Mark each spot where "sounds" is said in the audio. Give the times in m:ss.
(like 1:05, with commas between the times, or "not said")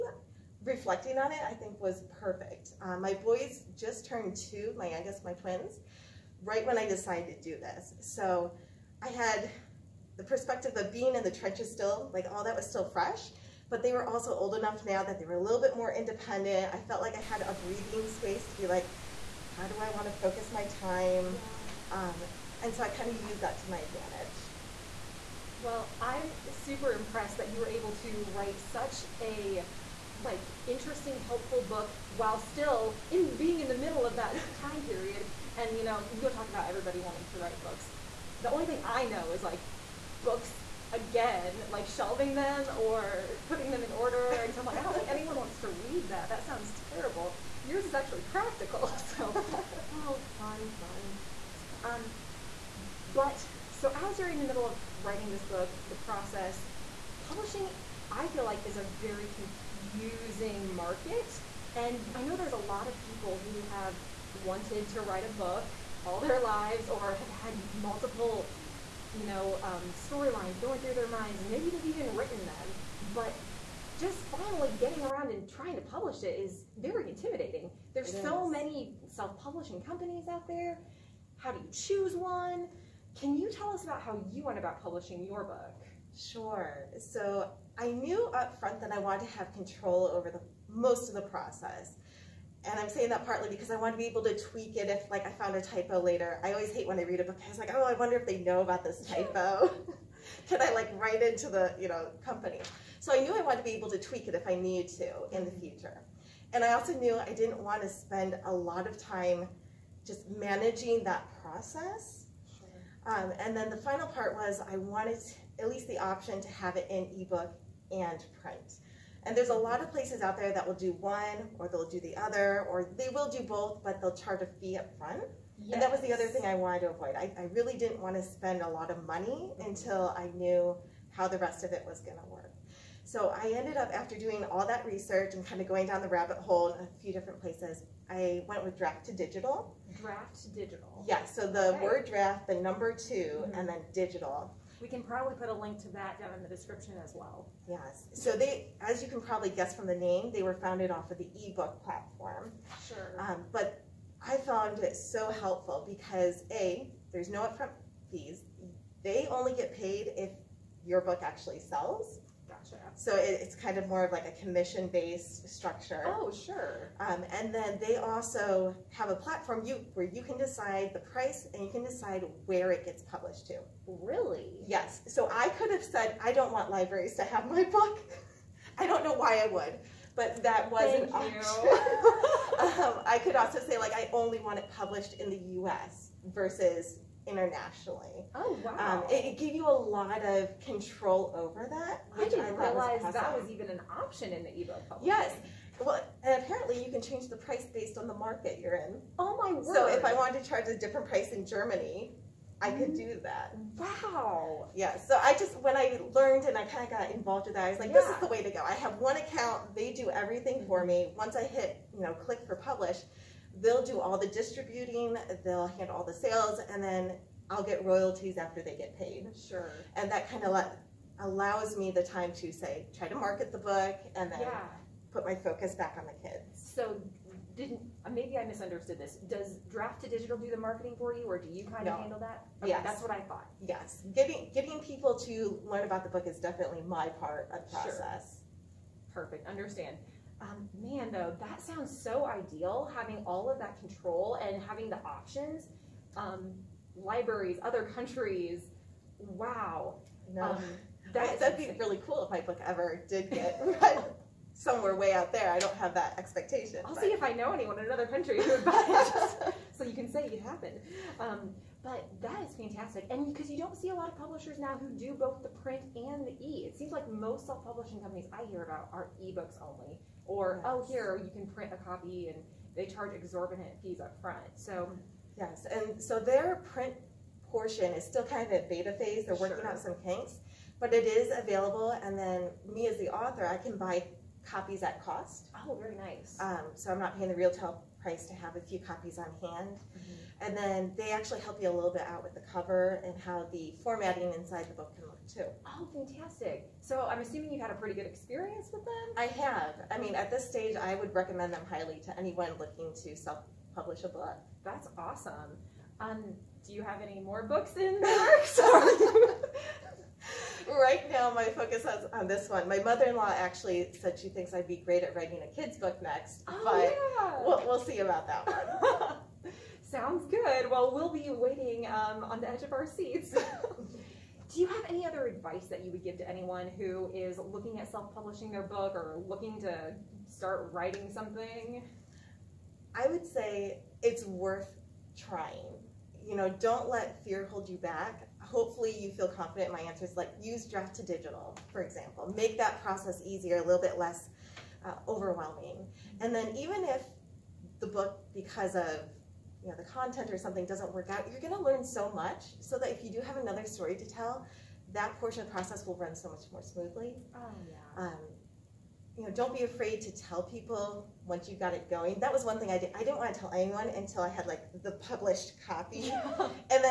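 0:46, 4:01, 5:19.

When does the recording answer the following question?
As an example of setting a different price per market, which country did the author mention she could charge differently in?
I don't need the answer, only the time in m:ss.
3:21.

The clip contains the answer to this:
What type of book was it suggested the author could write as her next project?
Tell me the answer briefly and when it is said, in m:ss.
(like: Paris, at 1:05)
A kid's book, at 5:15.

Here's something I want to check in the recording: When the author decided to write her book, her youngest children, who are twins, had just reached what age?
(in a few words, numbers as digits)
2.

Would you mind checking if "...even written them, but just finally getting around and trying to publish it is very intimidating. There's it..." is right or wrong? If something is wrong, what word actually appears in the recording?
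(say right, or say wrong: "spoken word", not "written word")
right.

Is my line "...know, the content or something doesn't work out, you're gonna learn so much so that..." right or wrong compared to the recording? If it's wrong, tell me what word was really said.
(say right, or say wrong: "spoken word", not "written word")
right.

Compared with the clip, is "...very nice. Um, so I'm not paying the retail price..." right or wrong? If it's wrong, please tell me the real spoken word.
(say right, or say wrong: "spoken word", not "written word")
right.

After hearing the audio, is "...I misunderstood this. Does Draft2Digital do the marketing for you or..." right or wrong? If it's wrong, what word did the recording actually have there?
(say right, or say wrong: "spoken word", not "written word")
right.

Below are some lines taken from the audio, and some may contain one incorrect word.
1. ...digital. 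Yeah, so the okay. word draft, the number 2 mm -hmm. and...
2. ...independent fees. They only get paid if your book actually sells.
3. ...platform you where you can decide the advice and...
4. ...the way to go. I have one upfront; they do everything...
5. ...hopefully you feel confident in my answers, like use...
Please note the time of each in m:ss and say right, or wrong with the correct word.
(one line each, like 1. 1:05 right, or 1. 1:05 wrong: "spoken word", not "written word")
1. 2:20 right
2. 2:37 wrong: "upfront", not "independent"
3. 2:49 wrong: "price", not "advice"
4. 3:28 wrong: "account", not "upfront"
5. 5:38 right.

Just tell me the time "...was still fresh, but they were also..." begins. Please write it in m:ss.
0:12.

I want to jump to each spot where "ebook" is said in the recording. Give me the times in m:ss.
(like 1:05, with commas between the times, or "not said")
1:57, 2:31, 3:14, 4:29.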